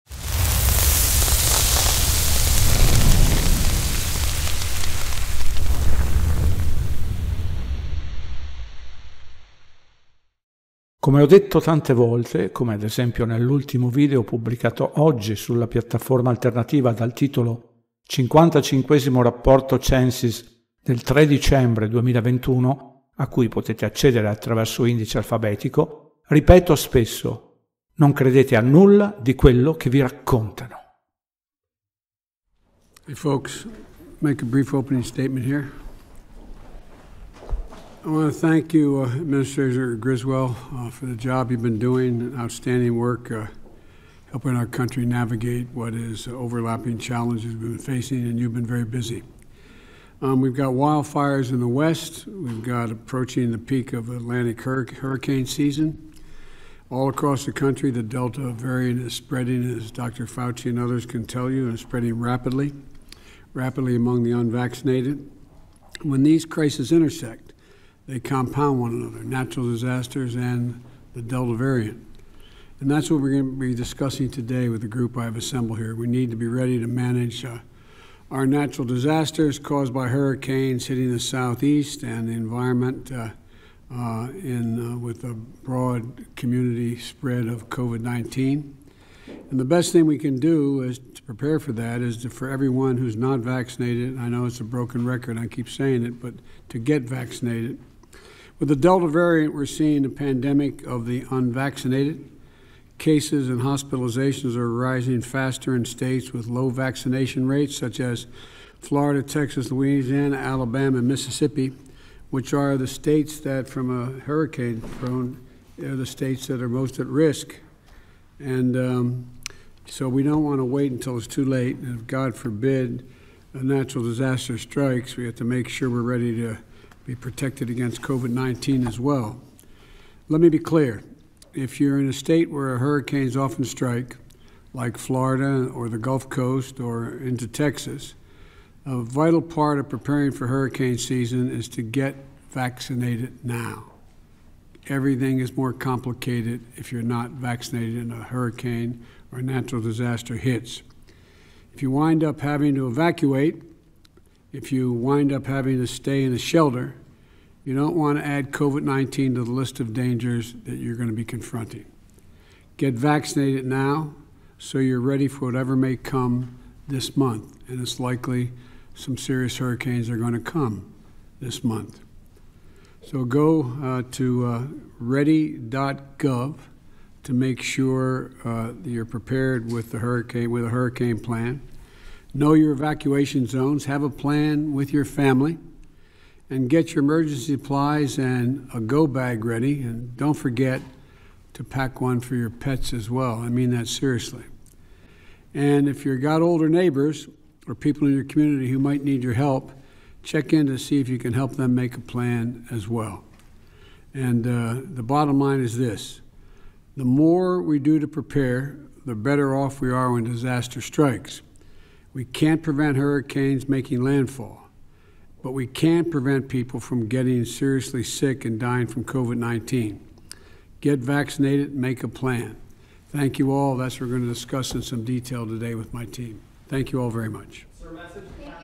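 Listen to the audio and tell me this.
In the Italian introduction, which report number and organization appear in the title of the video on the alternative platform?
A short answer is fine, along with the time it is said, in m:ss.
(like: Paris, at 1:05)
55 rapporto Censis, at 0:18.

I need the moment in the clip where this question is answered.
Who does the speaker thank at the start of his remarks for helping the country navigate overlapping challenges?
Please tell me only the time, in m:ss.
0:39.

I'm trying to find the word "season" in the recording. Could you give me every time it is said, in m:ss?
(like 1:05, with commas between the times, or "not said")
0:55, 2:20.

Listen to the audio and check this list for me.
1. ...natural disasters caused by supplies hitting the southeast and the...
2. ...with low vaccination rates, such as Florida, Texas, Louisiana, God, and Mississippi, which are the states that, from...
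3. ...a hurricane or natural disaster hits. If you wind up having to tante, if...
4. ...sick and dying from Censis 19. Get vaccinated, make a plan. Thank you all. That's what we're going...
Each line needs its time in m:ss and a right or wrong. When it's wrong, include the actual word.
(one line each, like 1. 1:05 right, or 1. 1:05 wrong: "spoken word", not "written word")
1. 1:18 wrong: "hurricanes", not "supplies"
2. 1:46 wrong: "Alabama", not "God"
3. 2:28 wrong: "evacuate", not "tante"
4. 3:38 wrong: "COVID", not "Censis".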